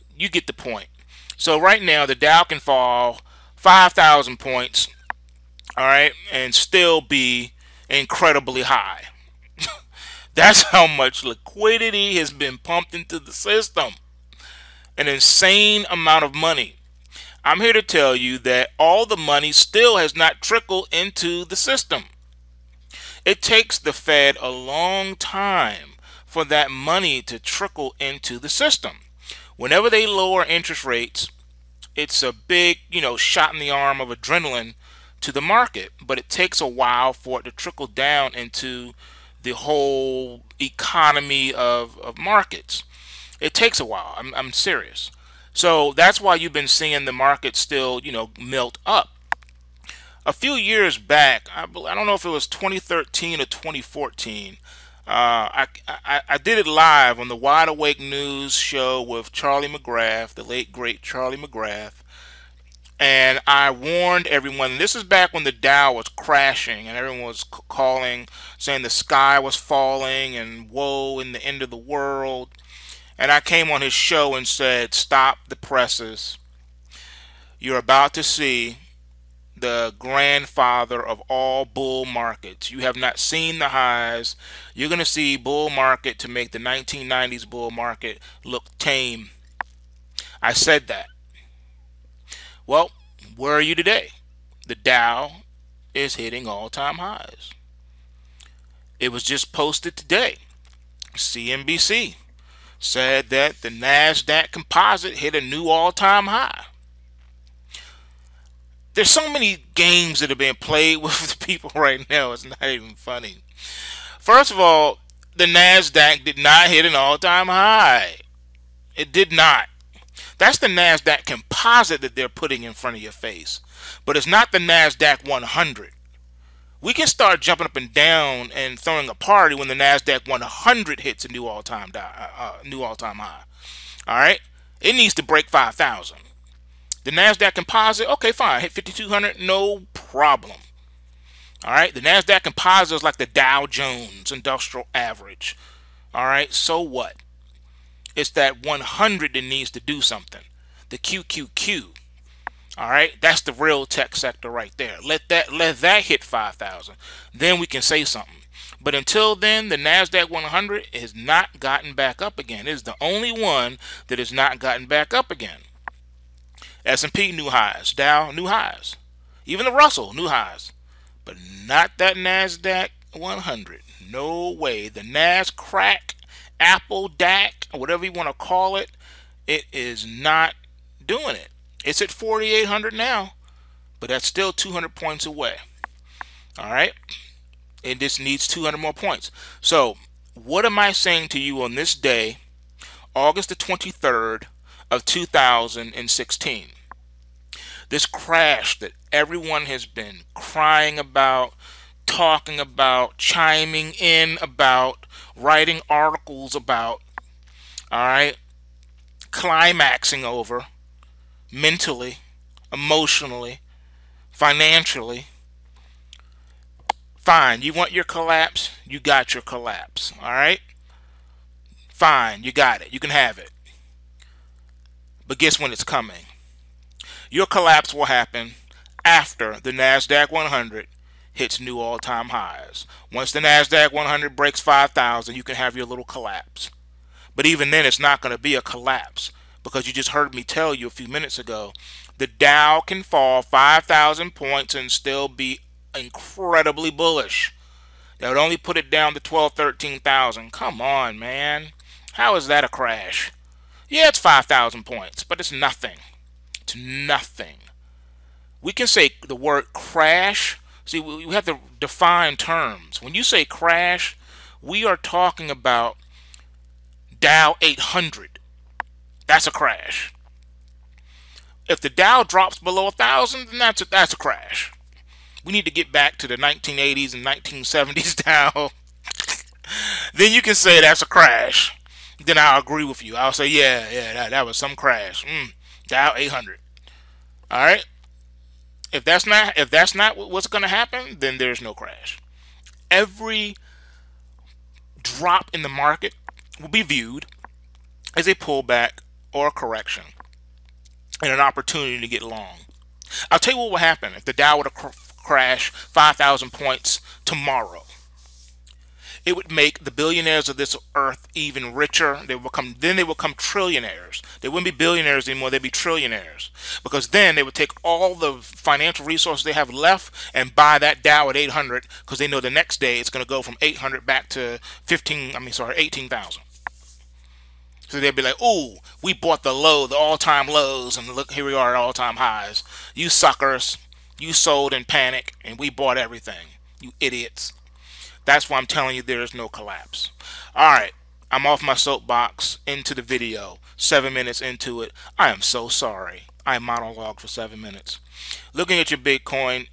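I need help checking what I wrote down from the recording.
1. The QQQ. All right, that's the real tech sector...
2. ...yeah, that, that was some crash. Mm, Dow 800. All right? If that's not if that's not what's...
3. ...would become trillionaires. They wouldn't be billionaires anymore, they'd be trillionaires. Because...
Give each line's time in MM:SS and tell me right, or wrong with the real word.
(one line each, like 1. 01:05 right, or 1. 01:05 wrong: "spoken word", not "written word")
1. 02:30 right
2. 04:43 right
3. 05:13 right.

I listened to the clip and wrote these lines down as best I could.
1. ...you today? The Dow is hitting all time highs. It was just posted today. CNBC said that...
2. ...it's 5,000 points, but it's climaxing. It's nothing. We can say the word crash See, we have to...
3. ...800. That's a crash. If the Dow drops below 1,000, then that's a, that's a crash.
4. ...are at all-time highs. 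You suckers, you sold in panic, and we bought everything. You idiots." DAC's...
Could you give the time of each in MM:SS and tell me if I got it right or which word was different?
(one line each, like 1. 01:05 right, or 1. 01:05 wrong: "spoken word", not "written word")
1. 01:33 right
2. 04:14 wrong: "nothing", not "climaxing"
3. 04:27 right
4. 05:31 wrong: "That", not "DAC".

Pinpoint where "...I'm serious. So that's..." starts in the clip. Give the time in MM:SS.
00:44.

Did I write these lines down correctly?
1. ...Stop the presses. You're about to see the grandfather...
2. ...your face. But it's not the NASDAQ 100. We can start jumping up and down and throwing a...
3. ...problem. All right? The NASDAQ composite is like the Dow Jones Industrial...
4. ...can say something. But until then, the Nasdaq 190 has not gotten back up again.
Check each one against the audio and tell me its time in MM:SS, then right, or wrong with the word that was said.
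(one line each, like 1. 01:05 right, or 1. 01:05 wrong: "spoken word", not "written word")
1. 01:14 right
2. 02:03 right
3. 02:19 right
4. 02:37 wrong: "100", not "190".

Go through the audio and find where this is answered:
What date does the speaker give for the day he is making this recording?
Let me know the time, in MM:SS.
03:13.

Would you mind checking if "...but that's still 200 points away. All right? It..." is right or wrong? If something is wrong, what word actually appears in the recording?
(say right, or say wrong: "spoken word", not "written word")
right.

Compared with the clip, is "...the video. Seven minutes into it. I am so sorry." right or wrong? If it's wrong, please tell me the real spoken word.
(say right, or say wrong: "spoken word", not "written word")
right.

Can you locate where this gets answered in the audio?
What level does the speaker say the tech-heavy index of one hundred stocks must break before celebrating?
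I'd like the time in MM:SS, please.
02:14.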